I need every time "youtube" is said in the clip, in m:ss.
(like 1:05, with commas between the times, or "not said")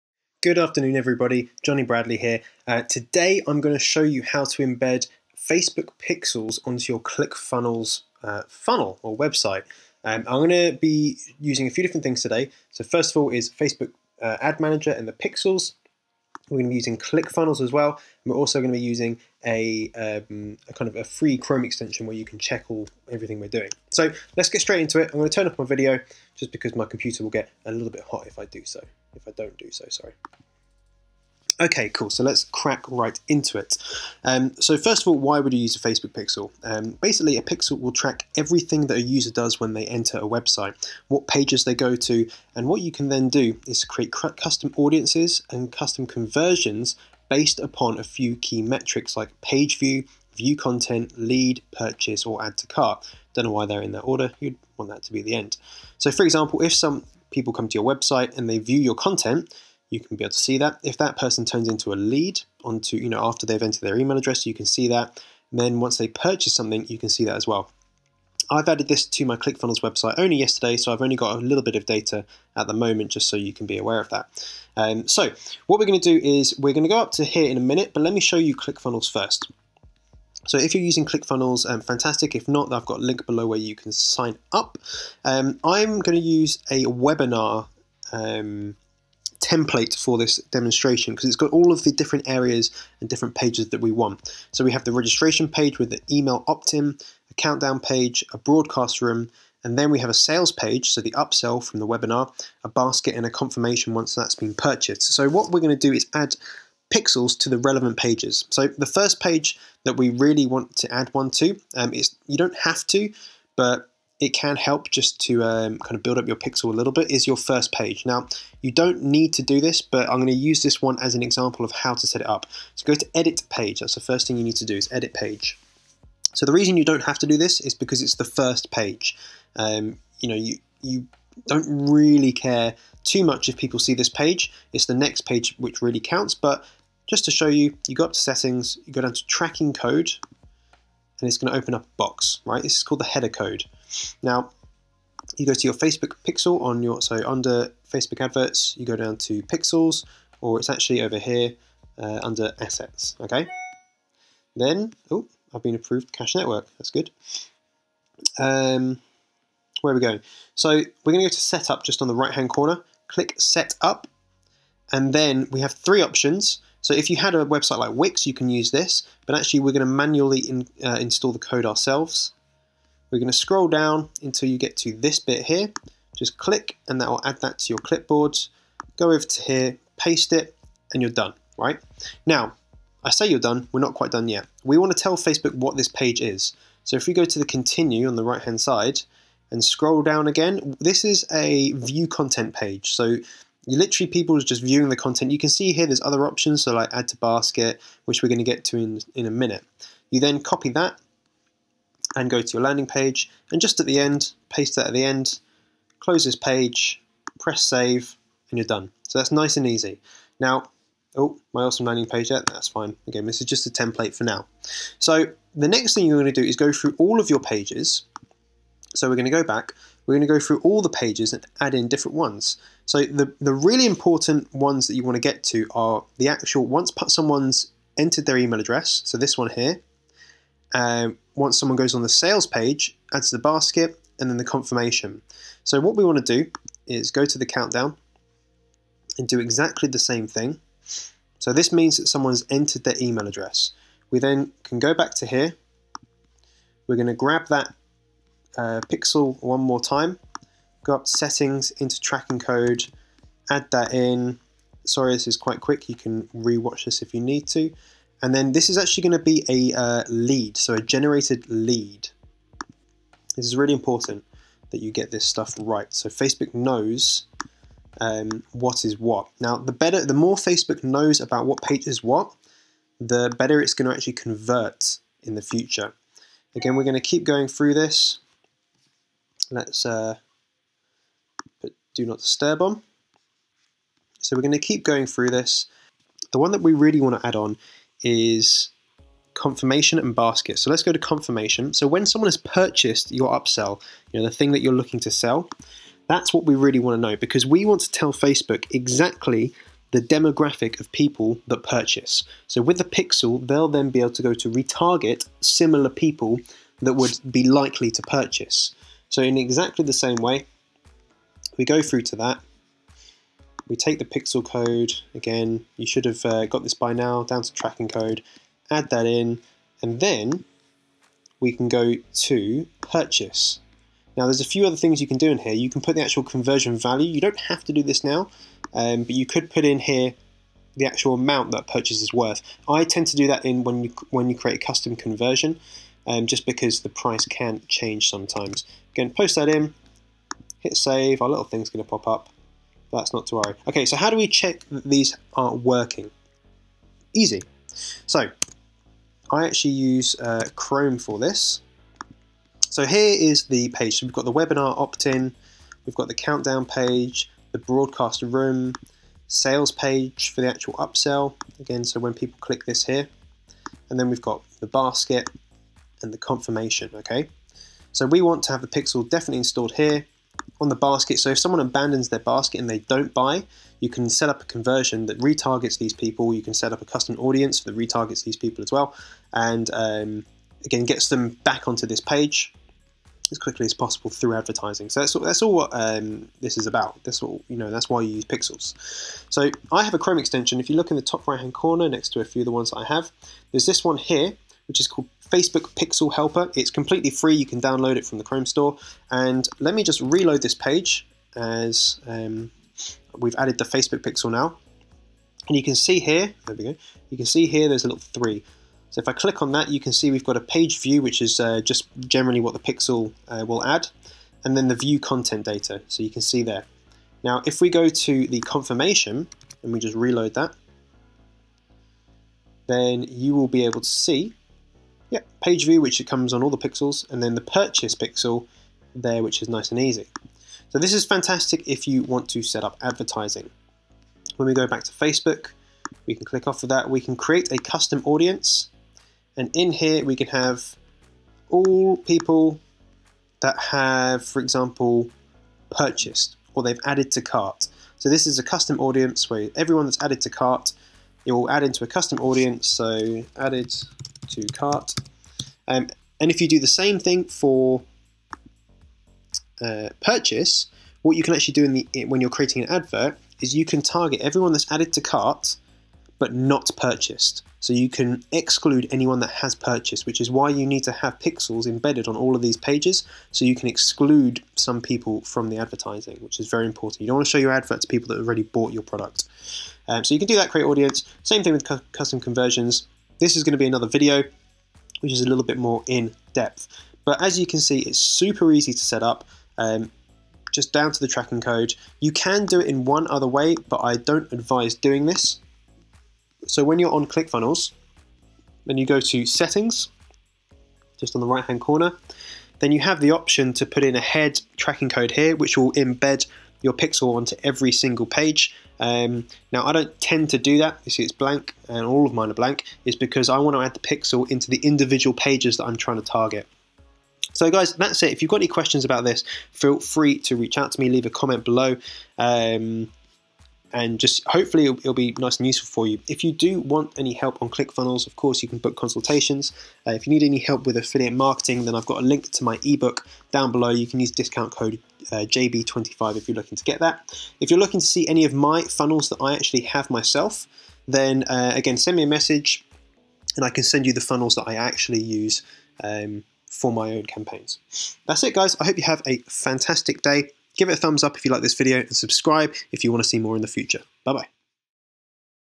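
not said.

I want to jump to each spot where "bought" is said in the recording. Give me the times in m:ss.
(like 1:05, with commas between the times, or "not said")
7:58.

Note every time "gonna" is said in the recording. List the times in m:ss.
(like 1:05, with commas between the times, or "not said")
2:00, 2:41.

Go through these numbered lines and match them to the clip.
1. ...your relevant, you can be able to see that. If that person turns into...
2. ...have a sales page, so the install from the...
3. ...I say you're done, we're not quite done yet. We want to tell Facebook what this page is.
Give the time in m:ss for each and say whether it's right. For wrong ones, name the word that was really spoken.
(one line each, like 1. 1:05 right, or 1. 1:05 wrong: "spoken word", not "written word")
1. 0:58 wrong: "content", not "relevant"
2. 1:39 wrong: "upsell", not "install"
3. 3:03 right.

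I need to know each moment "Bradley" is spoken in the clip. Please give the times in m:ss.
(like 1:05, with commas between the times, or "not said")
0:01.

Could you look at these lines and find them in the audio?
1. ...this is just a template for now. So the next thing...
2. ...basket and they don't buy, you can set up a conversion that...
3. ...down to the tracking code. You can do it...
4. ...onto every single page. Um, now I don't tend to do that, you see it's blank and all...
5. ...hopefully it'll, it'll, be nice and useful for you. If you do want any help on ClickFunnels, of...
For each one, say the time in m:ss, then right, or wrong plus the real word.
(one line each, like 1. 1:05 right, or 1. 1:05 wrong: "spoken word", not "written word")
1. 3:33 right
2. 6:12 right
3. 8:10 right
4. 8:27 right
5. 8:44 right.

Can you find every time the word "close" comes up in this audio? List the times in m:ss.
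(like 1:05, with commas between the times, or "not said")
3:25.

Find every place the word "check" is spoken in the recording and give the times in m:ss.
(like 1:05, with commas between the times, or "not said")
0:22, 5:44.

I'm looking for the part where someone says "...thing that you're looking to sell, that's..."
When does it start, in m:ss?
4:54.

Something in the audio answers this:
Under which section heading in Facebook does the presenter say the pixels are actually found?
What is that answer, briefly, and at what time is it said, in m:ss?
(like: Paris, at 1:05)
Assets, at 2:32.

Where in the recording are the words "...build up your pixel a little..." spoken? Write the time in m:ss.
1:56.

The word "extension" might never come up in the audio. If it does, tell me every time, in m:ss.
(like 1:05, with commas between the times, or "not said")
0:21, 6:30.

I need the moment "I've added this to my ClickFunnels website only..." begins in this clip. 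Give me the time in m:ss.
1:08.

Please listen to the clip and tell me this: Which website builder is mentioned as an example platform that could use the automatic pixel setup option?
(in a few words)
Wix.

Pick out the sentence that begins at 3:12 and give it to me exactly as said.
So you literally people is just viewing the content.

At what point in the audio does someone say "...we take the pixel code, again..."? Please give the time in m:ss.
5:13.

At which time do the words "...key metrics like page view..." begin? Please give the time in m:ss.
0:48.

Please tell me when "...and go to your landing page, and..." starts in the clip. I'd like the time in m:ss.
3:22.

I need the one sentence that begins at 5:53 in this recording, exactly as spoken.
So we've got the webinar opt-in, we've got the countdown page, the broadcast room, sales page for the actual upsell.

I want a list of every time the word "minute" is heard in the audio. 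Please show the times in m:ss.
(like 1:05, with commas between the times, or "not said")
1:17, 3:19.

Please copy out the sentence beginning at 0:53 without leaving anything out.
Don't know why they're in that order.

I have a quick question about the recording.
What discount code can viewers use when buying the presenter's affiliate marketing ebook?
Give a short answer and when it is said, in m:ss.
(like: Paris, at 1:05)
JB25, at 8:55.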